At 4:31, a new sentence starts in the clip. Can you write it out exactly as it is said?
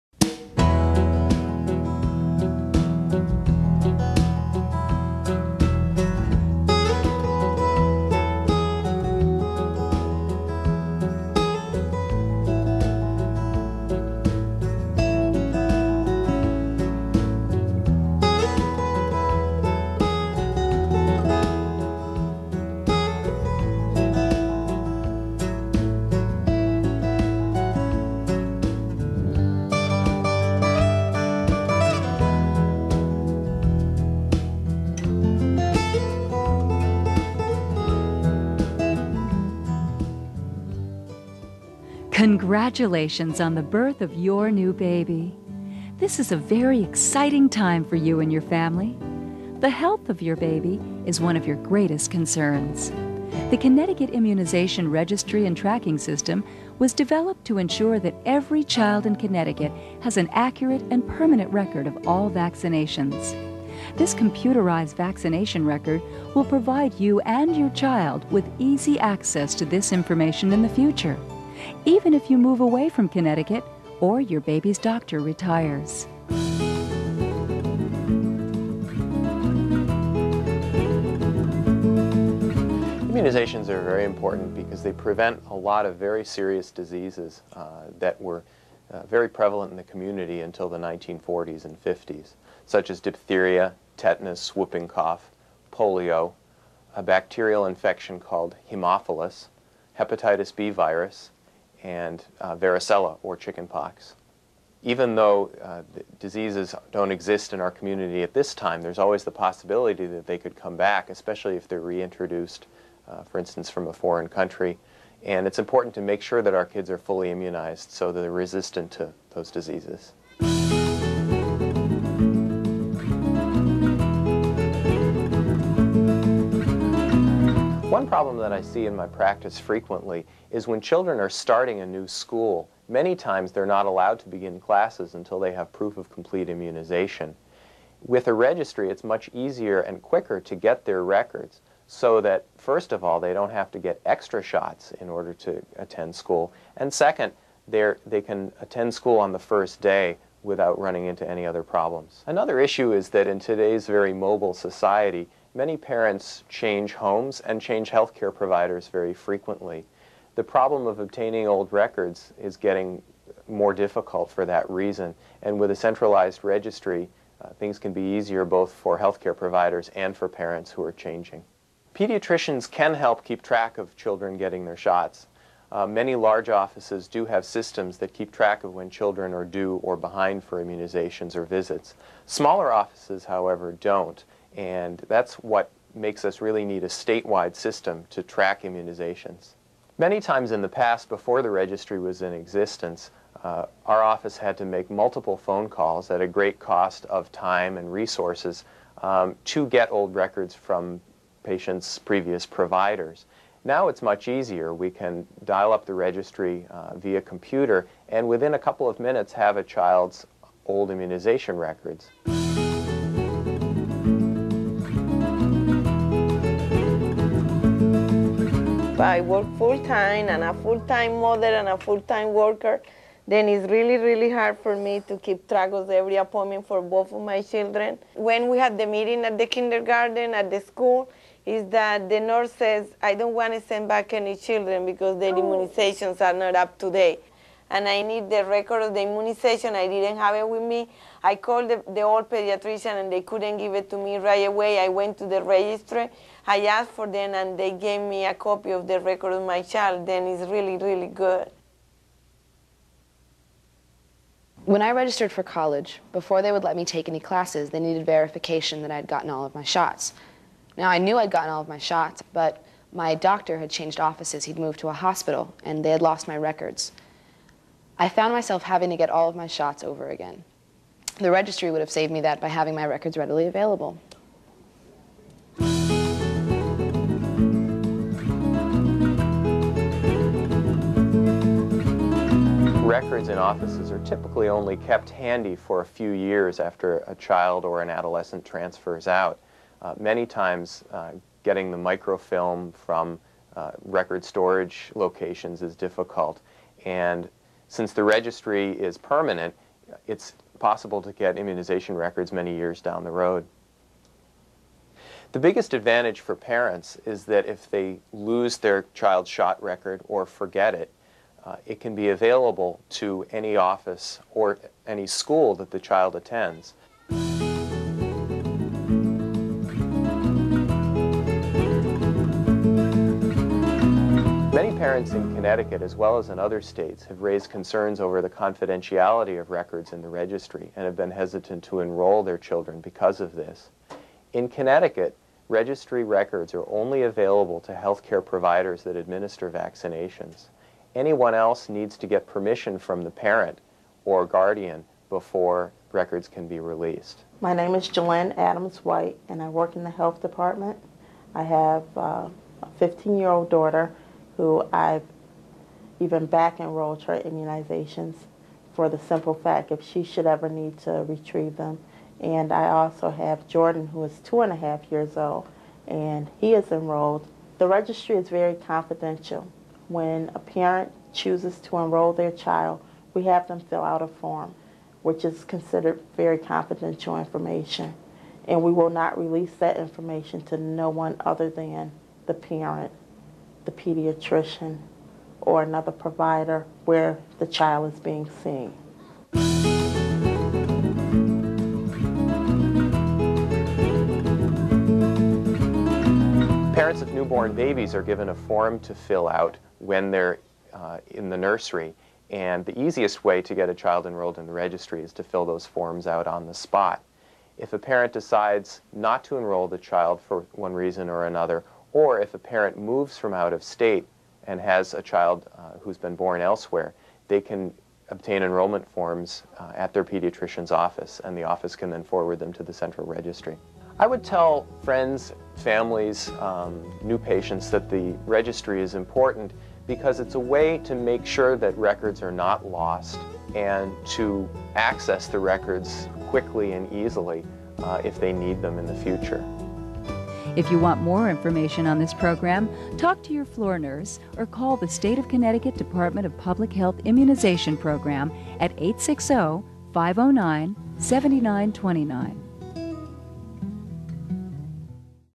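The registry would have saved me that by having my records readily available.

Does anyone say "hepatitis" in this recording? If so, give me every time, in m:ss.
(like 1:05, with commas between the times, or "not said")
1:39.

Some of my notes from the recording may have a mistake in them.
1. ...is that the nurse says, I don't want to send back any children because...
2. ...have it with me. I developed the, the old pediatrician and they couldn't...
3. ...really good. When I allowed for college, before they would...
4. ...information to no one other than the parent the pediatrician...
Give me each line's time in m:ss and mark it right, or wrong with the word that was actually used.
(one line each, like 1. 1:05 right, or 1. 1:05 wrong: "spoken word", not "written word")
1. 3:51 right
2. 4:00 wrong: "called", not "developed"
3. 4:10 wrong: "registered", not "allowed"
4. 6:19 right.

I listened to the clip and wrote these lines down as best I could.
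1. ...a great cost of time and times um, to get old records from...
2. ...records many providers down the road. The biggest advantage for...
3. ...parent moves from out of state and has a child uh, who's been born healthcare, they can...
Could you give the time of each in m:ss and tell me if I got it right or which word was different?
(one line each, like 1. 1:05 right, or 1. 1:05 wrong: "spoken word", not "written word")
1. 3:16 wrong: "resources", not "times"
2. 5:01 wrong: "years", not "providers"
3. 6:52 wrong: "elsewhere", not "healthcare".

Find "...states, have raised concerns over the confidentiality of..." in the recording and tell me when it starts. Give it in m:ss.
5:26.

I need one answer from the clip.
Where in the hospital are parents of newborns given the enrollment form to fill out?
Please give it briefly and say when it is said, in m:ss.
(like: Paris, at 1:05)
the nursery, at 6:41.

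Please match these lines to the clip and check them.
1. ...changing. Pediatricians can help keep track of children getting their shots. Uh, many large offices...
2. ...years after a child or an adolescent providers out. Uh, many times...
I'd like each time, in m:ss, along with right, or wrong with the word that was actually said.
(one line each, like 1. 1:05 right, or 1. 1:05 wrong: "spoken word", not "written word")
1. 2:50 right
2. 4:46 wrong: "transfers", not "providers".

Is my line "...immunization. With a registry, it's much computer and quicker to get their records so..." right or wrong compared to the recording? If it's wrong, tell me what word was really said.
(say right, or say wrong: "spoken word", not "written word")
wrong: "easier", not "computer".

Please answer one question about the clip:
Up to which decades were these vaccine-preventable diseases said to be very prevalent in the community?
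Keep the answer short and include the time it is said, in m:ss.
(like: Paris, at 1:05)
1940s and 50s, at 1:30.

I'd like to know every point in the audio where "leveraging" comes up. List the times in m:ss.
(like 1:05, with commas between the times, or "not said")
not said.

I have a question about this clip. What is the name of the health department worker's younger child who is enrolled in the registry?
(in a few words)
Jordan.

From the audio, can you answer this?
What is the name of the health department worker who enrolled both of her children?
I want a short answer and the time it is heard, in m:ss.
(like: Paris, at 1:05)
Jalen Adams White, at 5:47.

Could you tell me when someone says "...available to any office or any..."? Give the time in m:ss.
5:12.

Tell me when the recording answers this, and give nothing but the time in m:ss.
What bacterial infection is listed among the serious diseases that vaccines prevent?
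1:38.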